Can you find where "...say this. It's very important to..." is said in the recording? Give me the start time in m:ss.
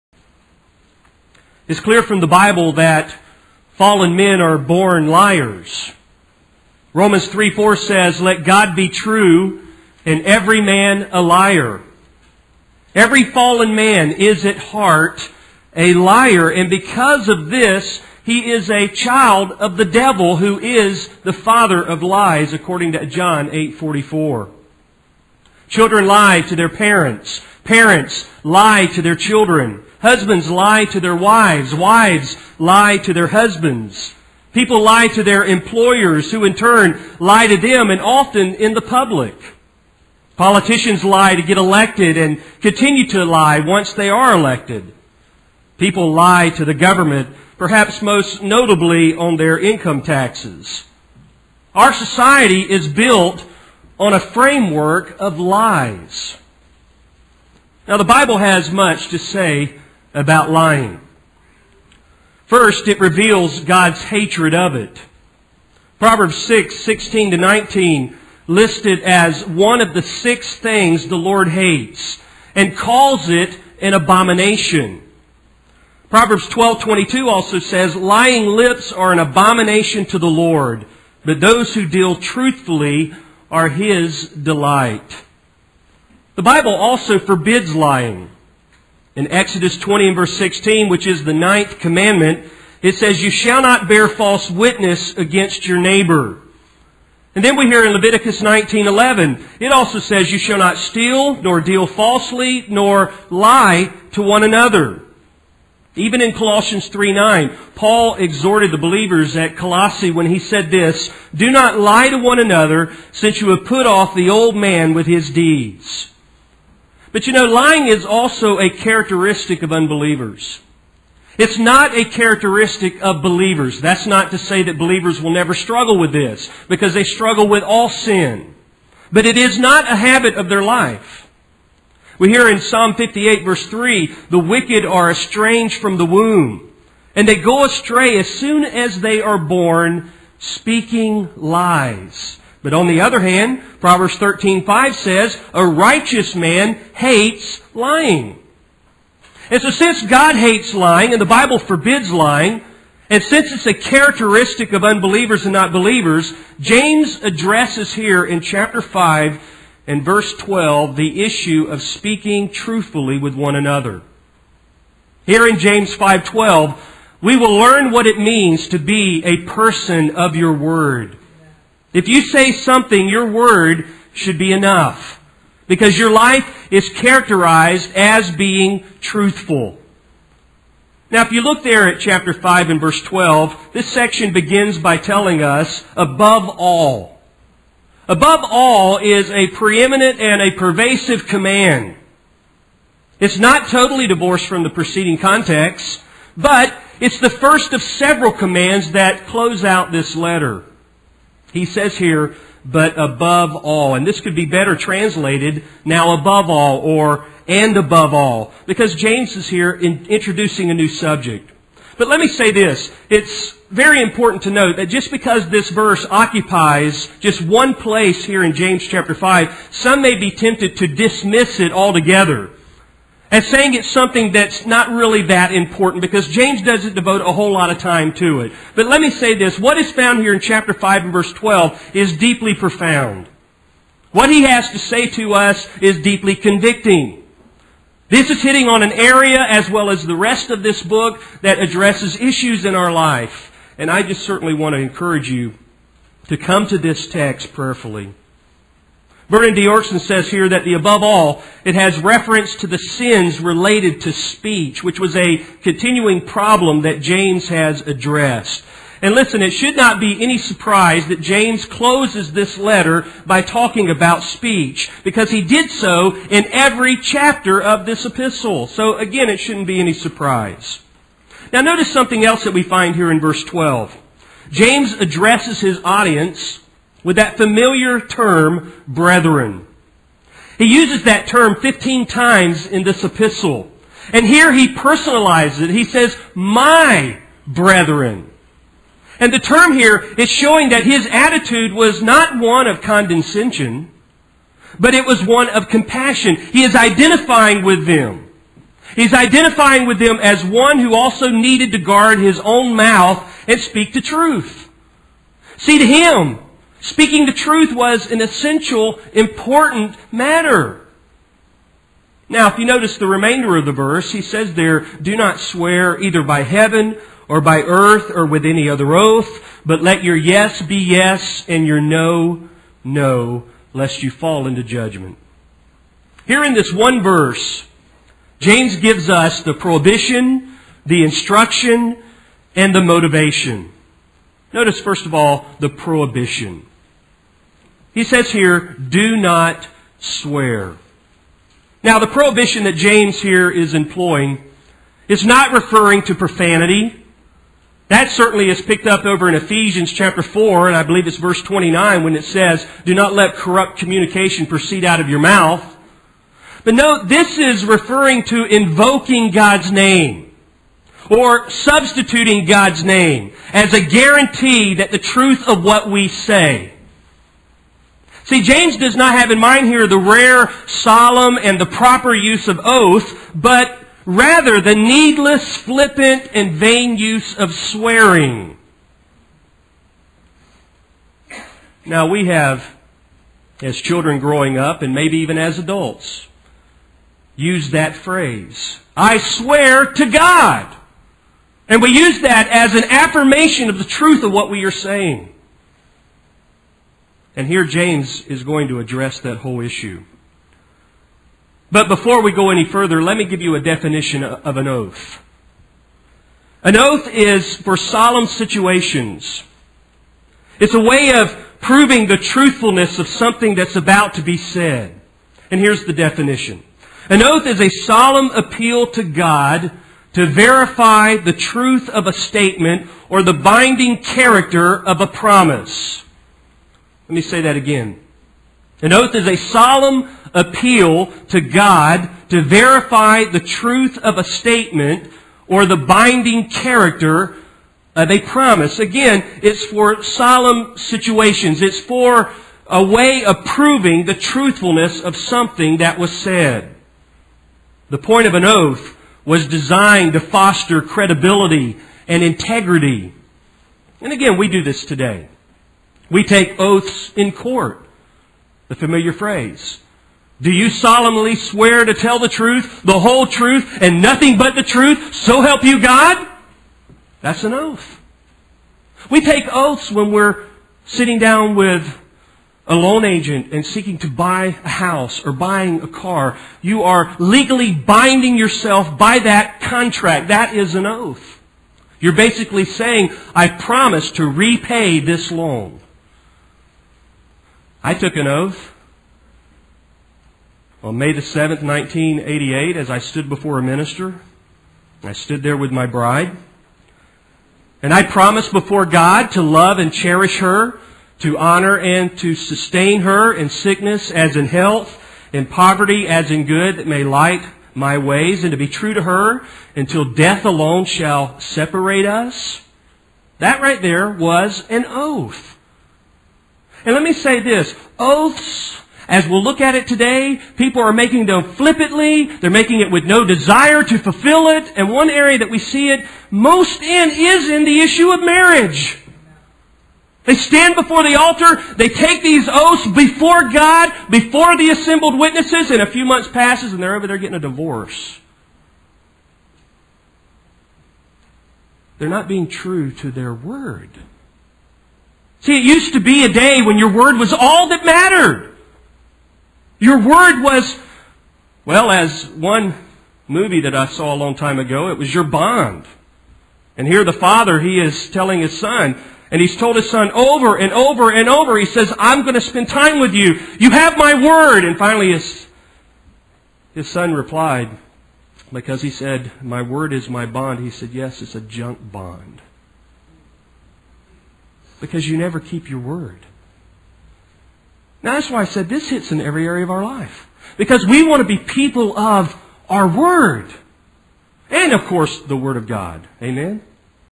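3:32.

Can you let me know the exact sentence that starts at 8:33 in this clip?
That right there was an oath.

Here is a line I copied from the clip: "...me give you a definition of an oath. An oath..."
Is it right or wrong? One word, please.
right.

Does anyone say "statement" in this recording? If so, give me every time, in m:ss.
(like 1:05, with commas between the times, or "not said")
7:02, 7:14.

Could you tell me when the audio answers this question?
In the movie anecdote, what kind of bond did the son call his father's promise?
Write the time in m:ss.
9:31.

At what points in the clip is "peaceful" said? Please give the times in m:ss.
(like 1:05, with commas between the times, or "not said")
not said.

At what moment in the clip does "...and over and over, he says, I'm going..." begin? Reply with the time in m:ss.
9:20.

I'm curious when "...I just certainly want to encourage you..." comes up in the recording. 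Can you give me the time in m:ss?
4:03.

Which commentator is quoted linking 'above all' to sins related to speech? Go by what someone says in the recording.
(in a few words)
Vernon Doerksen.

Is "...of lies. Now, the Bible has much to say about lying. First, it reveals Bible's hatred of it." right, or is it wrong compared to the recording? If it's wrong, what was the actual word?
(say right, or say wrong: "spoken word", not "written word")
wrong: "God", not "Bible".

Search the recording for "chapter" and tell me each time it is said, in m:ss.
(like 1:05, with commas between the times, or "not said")
2:38, 3:01, 3:38, 3:50, 4:26, 5:49.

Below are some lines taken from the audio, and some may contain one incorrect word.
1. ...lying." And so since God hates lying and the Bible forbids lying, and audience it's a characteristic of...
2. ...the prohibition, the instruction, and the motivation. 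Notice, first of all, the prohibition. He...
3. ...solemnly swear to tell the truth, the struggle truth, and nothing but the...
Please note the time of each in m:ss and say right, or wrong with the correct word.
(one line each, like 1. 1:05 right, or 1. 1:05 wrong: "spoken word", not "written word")
1. 2:27 wrong: "since", not "audience"
2. 5:29 right
3. 7:40 wrong: "whole", not "struggle".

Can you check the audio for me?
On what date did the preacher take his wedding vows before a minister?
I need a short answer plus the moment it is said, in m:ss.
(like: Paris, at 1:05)
May 7, 1988, at 8:10.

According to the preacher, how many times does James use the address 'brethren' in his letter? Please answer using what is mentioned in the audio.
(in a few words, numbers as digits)
15.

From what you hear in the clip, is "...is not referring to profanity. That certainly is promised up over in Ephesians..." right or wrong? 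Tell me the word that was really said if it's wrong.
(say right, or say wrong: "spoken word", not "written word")
wrong: "picked", not "promised".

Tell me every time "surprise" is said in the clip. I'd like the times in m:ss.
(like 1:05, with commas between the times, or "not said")
4:20, 4:29.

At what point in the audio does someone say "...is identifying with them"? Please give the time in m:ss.
4:56.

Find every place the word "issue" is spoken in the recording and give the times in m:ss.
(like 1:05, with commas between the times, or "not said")
2:41, 4:02, 6:39, 8:47.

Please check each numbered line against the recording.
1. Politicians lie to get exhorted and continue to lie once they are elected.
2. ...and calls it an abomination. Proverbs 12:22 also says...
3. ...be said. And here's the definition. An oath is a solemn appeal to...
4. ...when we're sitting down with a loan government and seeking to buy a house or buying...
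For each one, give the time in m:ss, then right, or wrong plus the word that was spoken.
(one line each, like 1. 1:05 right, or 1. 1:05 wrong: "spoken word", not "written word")
1. 0:40 wrong: "elected", not "exhorted"
2. 1:12 right
3. 6:54 right
4. 7:49 wrong: "agent", not "government".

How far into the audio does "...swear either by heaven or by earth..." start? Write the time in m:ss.
5:15.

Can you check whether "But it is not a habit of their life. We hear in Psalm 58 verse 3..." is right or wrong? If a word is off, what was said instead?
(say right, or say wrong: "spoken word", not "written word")
right.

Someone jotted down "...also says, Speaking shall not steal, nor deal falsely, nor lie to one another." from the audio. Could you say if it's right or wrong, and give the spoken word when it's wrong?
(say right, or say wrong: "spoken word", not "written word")
wrong: "You", not "Speaking".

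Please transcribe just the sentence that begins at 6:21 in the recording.
Now, we have, as children growing up, and maybe even as adults, used that phrase I swear to God.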